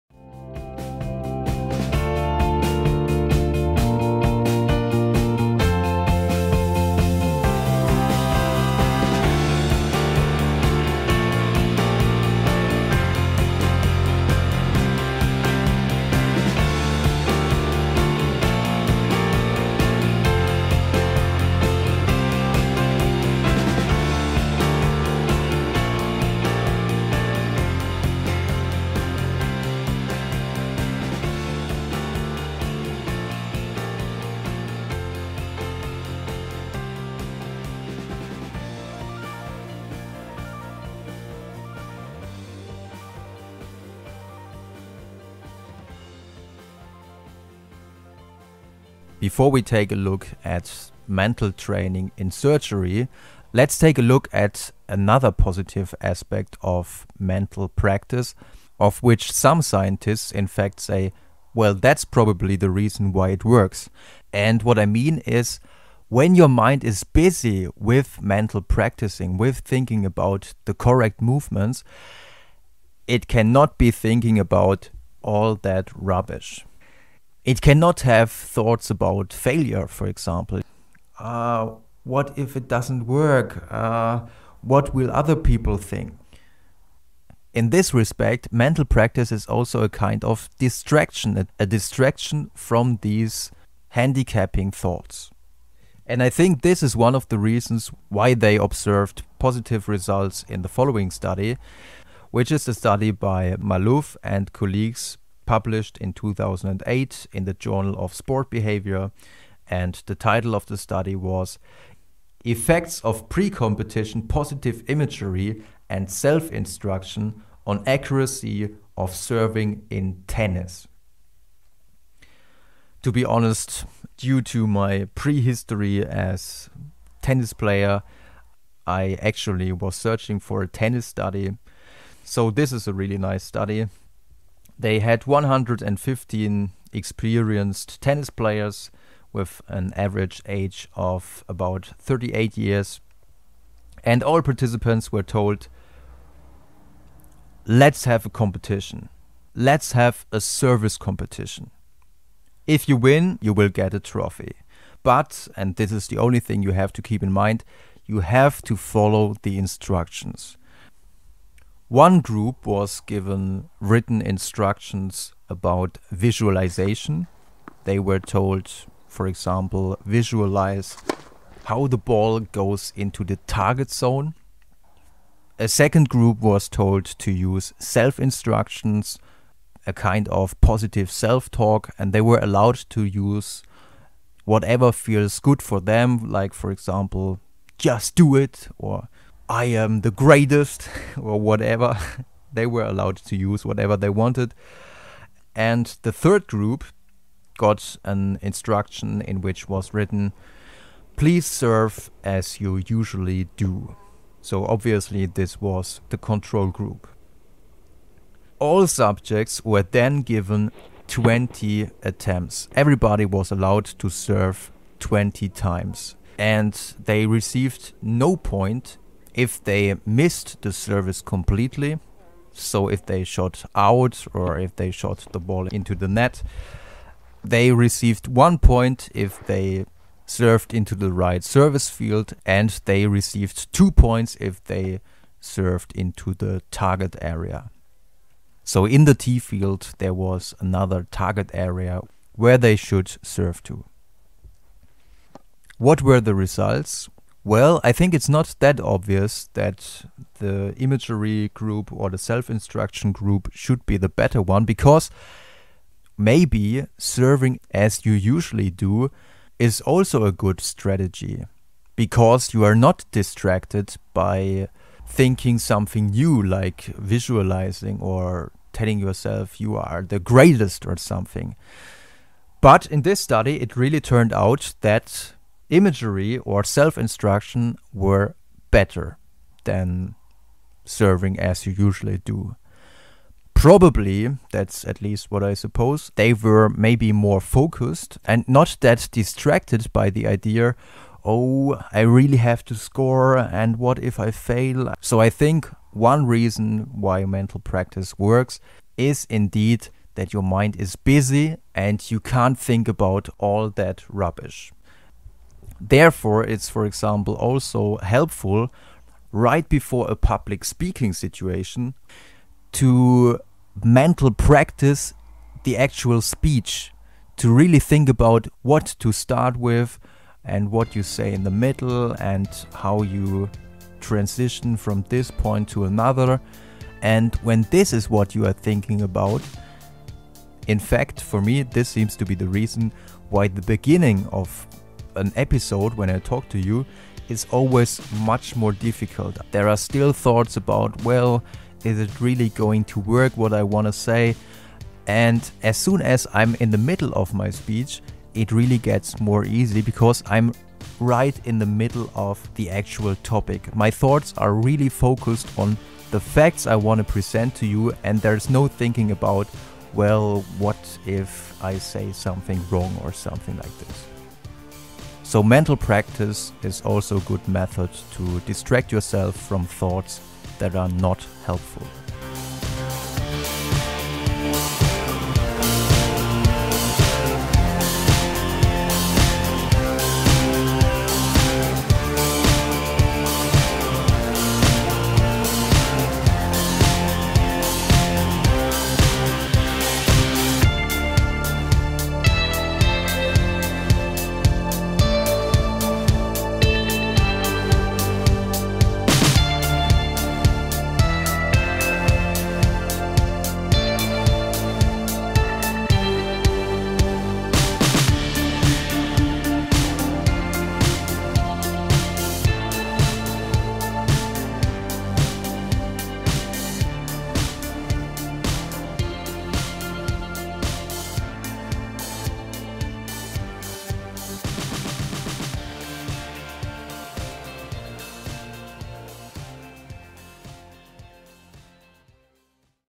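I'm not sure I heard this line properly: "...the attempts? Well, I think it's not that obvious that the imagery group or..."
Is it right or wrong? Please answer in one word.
wrong.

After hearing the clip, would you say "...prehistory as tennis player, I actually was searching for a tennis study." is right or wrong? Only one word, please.
right.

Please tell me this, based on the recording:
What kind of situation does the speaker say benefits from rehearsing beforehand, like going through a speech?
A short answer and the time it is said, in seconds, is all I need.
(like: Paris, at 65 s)
public speaking, at 310 s.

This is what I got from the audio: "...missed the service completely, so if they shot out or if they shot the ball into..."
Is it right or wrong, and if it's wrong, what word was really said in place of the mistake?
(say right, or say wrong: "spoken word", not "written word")
right.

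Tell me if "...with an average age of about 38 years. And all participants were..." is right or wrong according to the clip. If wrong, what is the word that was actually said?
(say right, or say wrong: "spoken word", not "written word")
right.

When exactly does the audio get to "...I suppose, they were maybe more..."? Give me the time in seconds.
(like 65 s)
285 s.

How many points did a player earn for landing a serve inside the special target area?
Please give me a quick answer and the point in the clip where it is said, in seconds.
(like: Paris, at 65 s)
2, at 233 s.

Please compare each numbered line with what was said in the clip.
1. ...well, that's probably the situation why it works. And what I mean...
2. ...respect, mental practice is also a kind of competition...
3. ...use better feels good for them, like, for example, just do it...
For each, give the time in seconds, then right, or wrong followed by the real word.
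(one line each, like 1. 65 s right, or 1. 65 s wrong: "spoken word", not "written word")
1. 61 s wrong: "reason", not "situation"
2. 87 s wrong: "distraction", not "competition"
3. 183 s wrong: "whatever", not "better".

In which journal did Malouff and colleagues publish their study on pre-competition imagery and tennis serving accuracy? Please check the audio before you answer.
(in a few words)
Journal of Sport Behavior.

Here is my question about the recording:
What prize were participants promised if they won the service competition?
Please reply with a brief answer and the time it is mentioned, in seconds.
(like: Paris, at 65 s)
a trophy, at 153 s.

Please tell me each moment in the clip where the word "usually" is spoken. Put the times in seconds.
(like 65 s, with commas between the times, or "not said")
202 s, 258 s, 281 s.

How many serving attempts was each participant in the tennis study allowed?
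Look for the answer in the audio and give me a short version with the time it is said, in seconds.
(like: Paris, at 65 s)
20, at 211 s.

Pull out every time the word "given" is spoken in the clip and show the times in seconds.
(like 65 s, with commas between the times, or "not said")
163 s, 210 s.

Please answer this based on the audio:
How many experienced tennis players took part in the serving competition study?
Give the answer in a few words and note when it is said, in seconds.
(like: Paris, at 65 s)
115, at 135 s.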